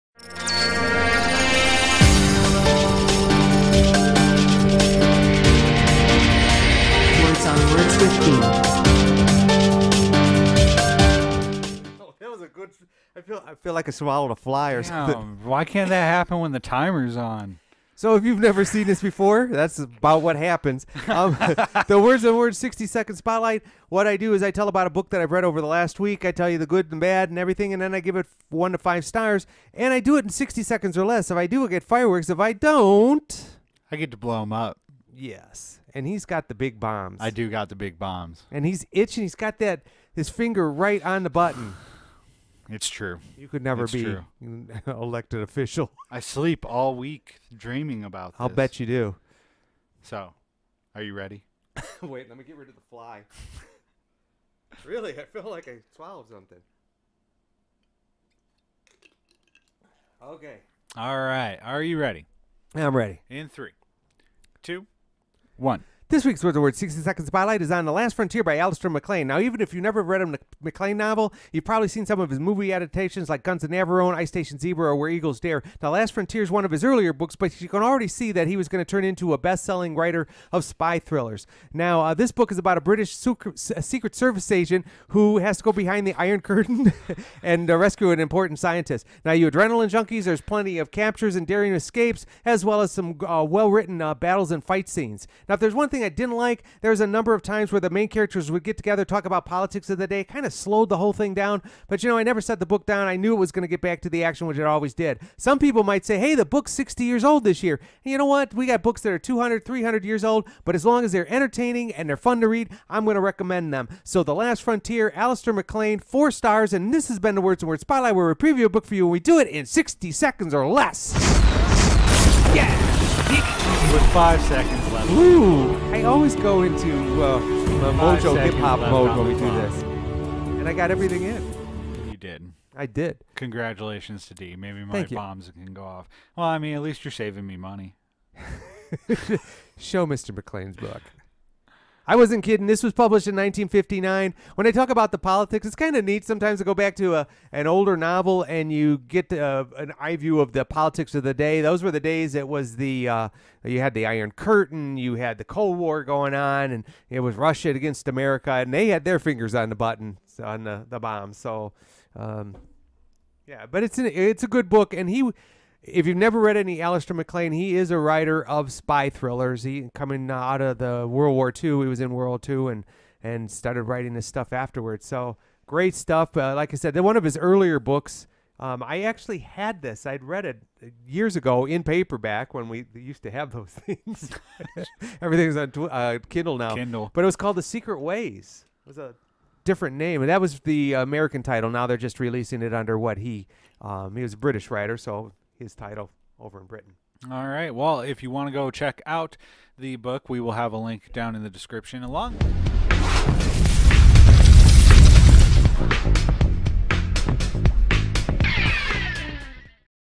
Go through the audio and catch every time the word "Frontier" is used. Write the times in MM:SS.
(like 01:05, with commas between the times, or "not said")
01:08, 01:16, 01:54.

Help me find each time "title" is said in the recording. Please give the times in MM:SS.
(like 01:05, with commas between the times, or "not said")
03:11, 03:15.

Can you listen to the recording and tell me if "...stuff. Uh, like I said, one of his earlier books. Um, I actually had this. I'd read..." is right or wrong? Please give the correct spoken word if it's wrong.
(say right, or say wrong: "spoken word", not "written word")
right.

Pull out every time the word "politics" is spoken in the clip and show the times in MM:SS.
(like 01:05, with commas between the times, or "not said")
01:39, 02:25, 02:30.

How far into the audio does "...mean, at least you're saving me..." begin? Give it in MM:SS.
02:16.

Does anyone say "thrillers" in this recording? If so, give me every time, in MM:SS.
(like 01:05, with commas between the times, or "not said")
01:20, 02:49.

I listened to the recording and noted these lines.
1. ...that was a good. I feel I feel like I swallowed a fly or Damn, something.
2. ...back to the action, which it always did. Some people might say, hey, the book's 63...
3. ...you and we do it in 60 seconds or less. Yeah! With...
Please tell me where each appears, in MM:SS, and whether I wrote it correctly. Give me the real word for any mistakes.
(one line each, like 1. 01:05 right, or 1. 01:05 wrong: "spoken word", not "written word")
1. 00:12 right
2. 01:43 wrong: "60", not "63"
3. 01:58 right.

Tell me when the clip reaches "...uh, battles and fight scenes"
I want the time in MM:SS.
01:34.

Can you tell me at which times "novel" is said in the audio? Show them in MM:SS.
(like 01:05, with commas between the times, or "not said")
01:10, 02:27.